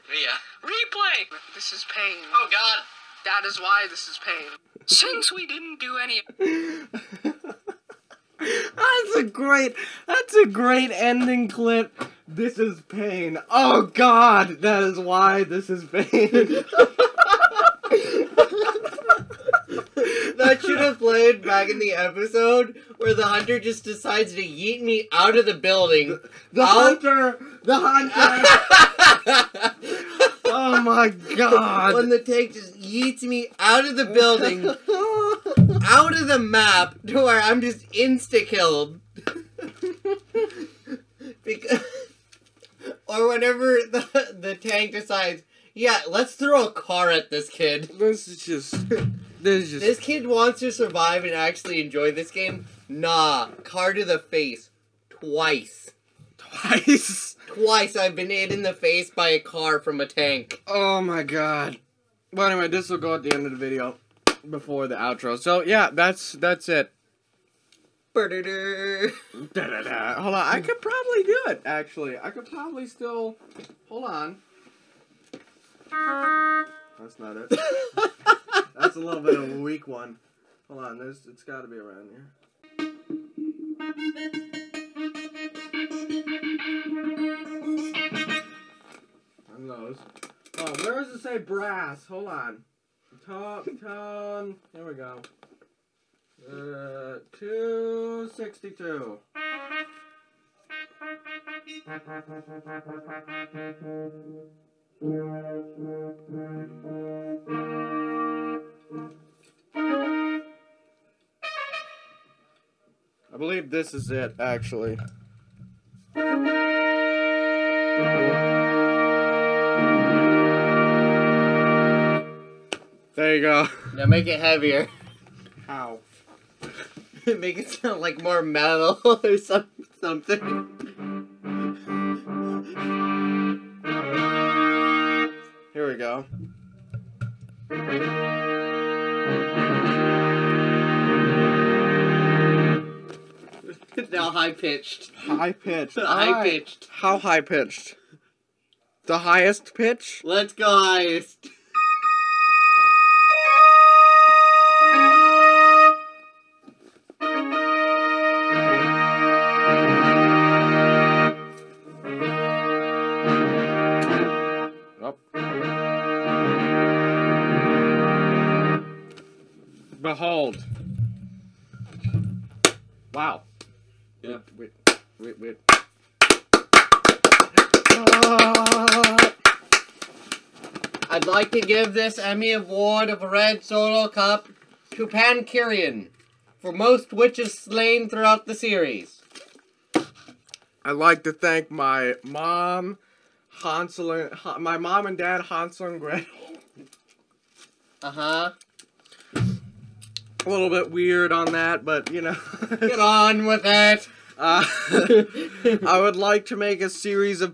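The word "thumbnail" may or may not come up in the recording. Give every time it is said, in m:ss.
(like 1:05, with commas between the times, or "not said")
not said.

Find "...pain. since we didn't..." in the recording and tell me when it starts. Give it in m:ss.
0:04.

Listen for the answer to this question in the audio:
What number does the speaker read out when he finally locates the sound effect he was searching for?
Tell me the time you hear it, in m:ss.
1:37.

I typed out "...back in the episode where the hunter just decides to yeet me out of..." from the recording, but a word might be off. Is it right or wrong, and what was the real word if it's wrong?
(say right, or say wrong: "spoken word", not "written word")
right.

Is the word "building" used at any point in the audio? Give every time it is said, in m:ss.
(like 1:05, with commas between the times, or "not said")
0:25, 0:34.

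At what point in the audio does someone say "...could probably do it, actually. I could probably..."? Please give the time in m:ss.
1:10.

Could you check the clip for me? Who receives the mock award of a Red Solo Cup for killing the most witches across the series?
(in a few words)
Pankierin.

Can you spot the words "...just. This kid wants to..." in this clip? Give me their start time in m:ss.
0:49.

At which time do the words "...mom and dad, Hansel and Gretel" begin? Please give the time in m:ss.
3:14.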